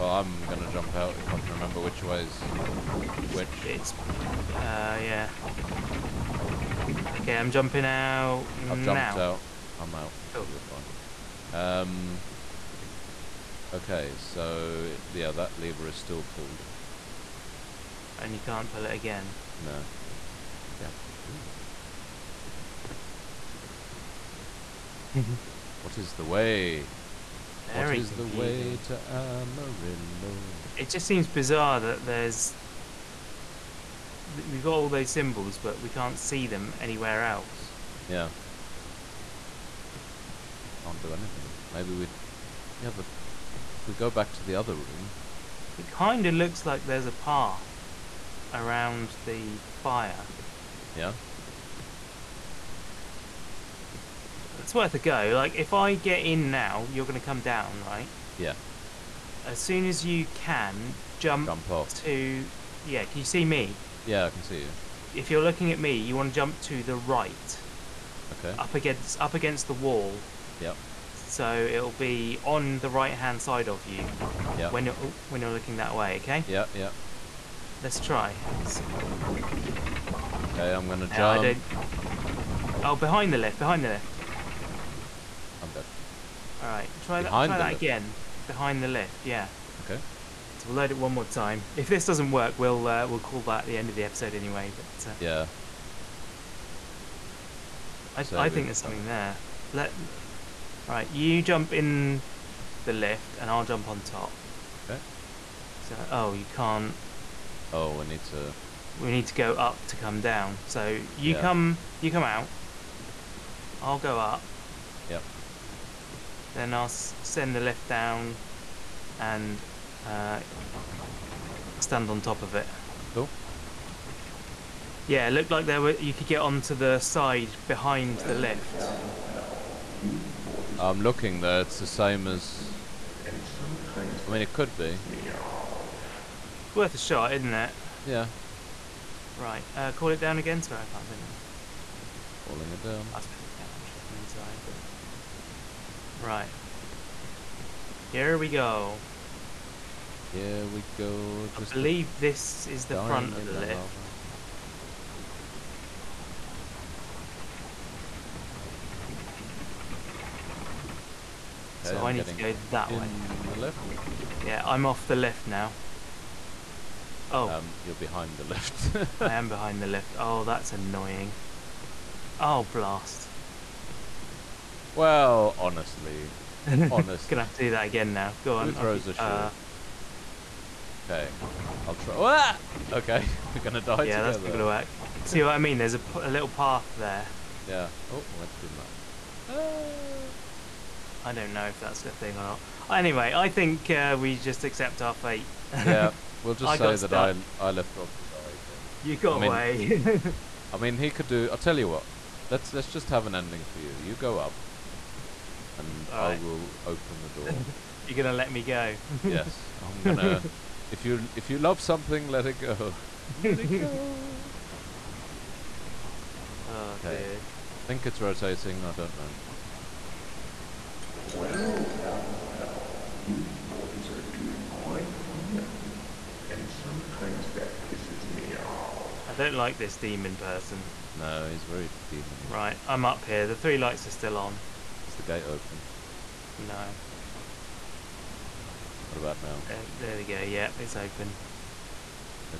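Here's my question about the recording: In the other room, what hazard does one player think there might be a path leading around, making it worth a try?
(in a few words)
fire.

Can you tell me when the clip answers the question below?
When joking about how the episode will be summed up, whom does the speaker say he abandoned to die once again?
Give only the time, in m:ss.
3:17.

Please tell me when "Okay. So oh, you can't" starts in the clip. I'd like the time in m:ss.
1:44.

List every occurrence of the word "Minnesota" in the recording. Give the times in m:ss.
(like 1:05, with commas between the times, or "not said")
not said.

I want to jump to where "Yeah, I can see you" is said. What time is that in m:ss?
1:04.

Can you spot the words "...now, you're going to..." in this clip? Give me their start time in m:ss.
0:56.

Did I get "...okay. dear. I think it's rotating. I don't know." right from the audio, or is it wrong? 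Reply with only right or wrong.
right.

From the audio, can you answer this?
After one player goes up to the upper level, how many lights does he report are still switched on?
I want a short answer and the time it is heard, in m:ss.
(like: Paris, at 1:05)
3, at 3:53.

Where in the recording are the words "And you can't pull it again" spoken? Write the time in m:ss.
0:18.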